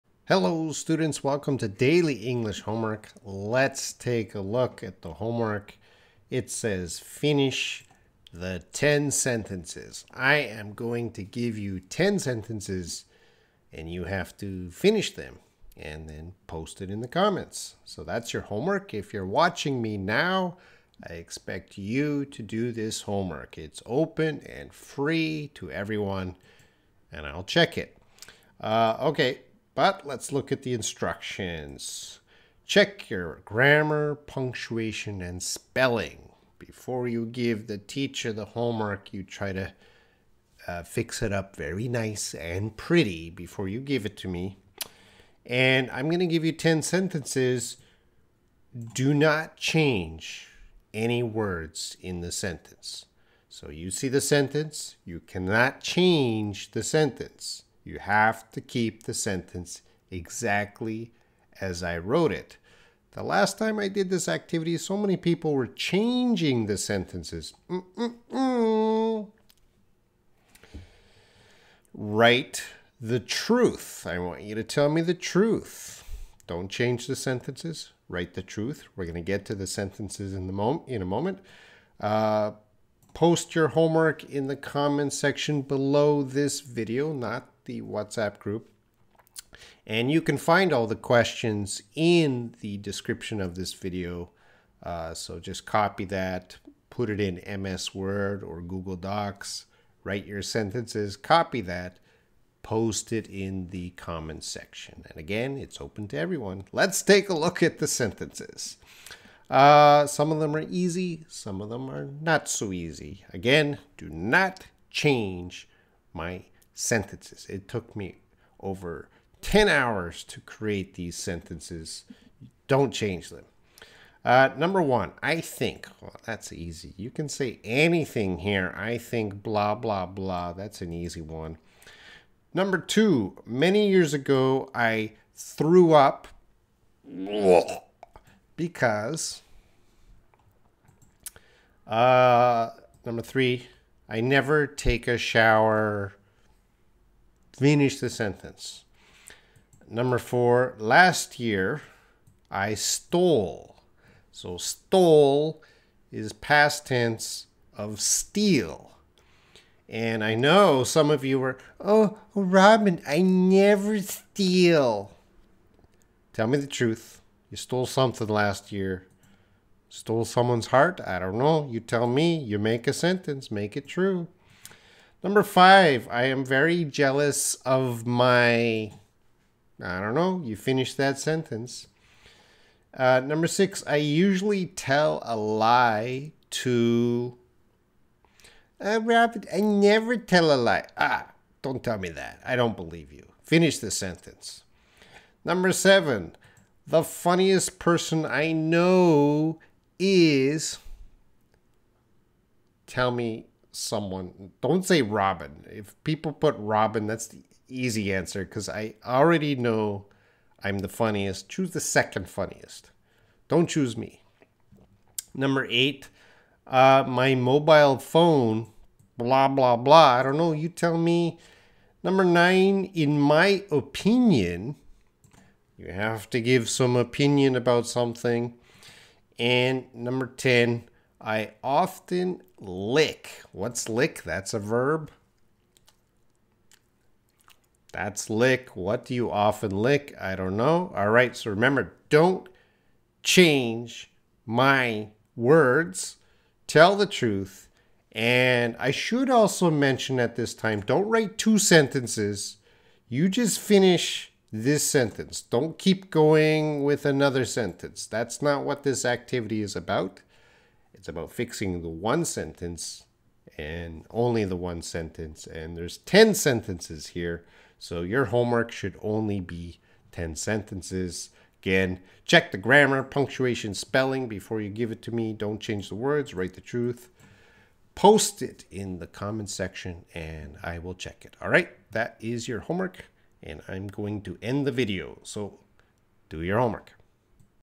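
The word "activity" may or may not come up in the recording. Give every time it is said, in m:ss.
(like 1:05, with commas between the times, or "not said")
1:04, 4:19.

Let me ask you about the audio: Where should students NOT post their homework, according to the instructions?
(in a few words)
the WhatsApp group.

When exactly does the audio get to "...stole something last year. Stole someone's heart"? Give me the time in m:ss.
2:47.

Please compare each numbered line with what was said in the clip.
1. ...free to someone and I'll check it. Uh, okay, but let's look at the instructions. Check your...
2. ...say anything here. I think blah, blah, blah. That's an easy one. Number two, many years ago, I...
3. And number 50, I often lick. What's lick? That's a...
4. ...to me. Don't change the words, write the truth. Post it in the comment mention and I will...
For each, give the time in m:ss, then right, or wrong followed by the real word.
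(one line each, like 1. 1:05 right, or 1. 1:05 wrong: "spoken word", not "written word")
1. 0:24 wrong: "everyone", not "someone"
2. 2:07 right
3. 3:49 wrong: "10", not "50"
4. 4:35 wrong: "section", not "mention".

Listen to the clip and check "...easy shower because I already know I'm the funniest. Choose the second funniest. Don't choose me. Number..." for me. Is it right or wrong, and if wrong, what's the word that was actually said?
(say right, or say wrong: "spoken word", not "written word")
wrong: "answer", not "shower".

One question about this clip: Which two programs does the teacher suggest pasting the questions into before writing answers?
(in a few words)
MS Word or Google Docs.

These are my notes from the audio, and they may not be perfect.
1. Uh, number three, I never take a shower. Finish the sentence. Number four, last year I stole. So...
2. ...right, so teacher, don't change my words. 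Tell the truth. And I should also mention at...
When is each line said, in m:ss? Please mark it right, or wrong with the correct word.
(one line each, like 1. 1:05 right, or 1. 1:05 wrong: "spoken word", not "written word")
1. 2:21 right
2. 4:01 wrong: "remember", not "teacher".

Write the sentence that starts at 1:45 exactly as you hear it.
And again, it's open to everyone.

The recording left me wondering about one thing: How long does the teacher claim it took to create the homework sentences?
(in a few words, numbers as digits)
over 10 hours.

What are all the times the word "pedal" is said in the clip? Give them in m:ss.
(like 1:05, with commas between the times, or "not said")
not said.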